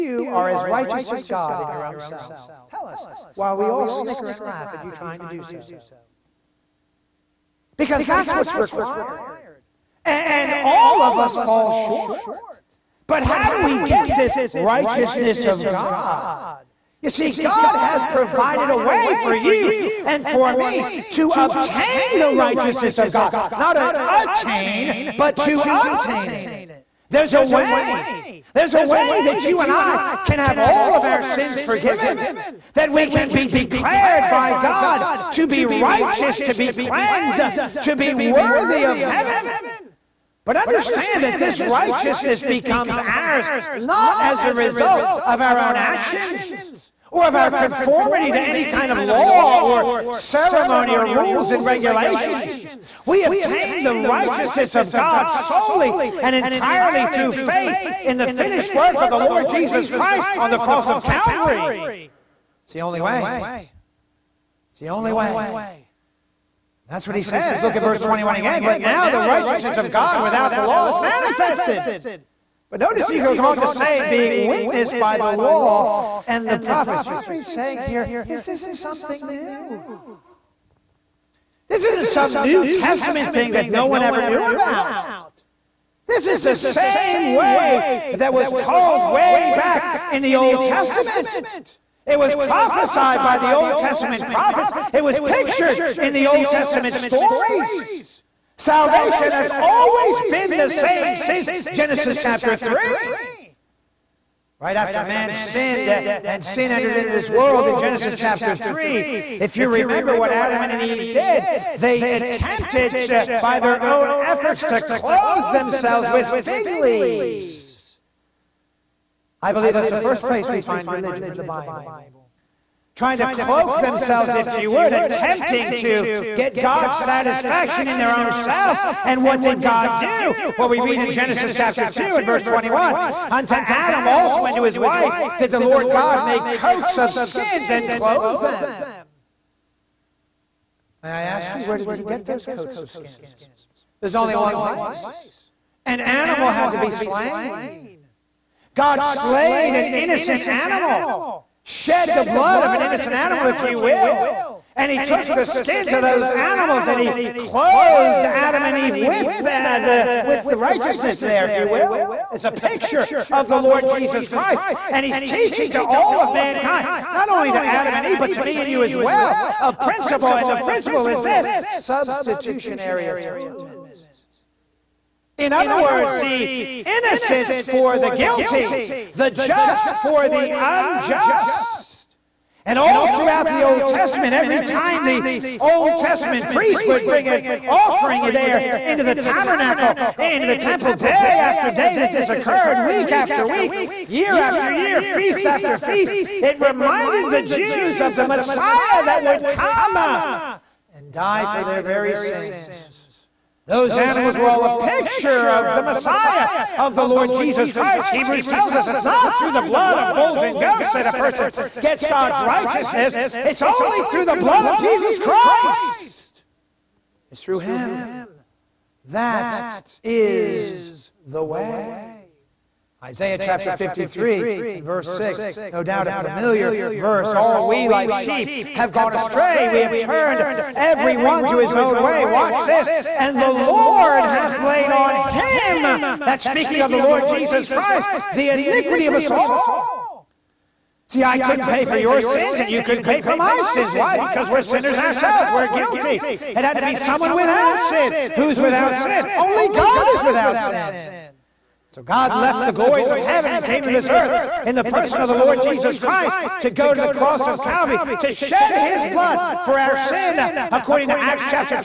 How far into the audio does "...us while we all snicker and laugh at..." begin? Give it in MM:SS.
00:02.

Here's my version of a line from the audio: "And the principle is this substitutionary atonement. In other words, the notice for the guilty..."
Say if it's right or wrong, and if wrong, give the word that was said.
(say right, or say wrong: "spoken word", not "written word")
wrong: "innocence", not "notice".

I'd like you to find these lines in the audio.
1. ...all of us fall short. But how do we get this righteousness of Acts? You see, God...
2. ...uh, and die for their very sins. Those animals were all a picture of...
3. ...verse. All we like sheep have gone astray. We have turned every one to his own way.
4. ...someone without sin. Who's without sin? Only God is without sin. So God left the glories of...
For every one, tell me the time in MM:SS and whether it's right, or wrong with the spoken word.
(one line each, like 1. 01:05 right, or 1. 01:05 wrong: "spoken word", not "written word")
1. 00:10 wrong: "God", not "Acts"
2. 03:19 right
3. 03:46 right
4. 04:06 right.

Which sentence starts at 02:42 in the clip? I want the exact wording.
It's a picture of the Lord Jesus Christ.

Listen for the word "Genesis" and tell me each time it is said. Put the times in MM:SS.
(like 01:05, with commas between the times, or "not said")
01:41, 01:47, 02:11.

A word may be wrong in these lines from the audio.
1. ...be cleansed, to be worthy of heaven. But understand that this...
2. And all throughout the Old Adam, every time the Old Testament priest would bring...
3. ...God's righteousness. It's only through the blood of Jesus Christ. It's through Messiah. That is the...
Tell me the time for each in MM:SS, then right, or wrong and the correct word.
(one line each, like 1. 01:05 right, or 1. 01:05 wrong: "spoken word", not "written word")
1. 00:36 right
2. 03:02 wrong: "Testament", not "Adam"
3. 03:32 wrong: "Him", not "Messiah".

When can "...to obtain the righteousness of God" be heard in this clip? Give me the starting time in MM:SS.
00:21.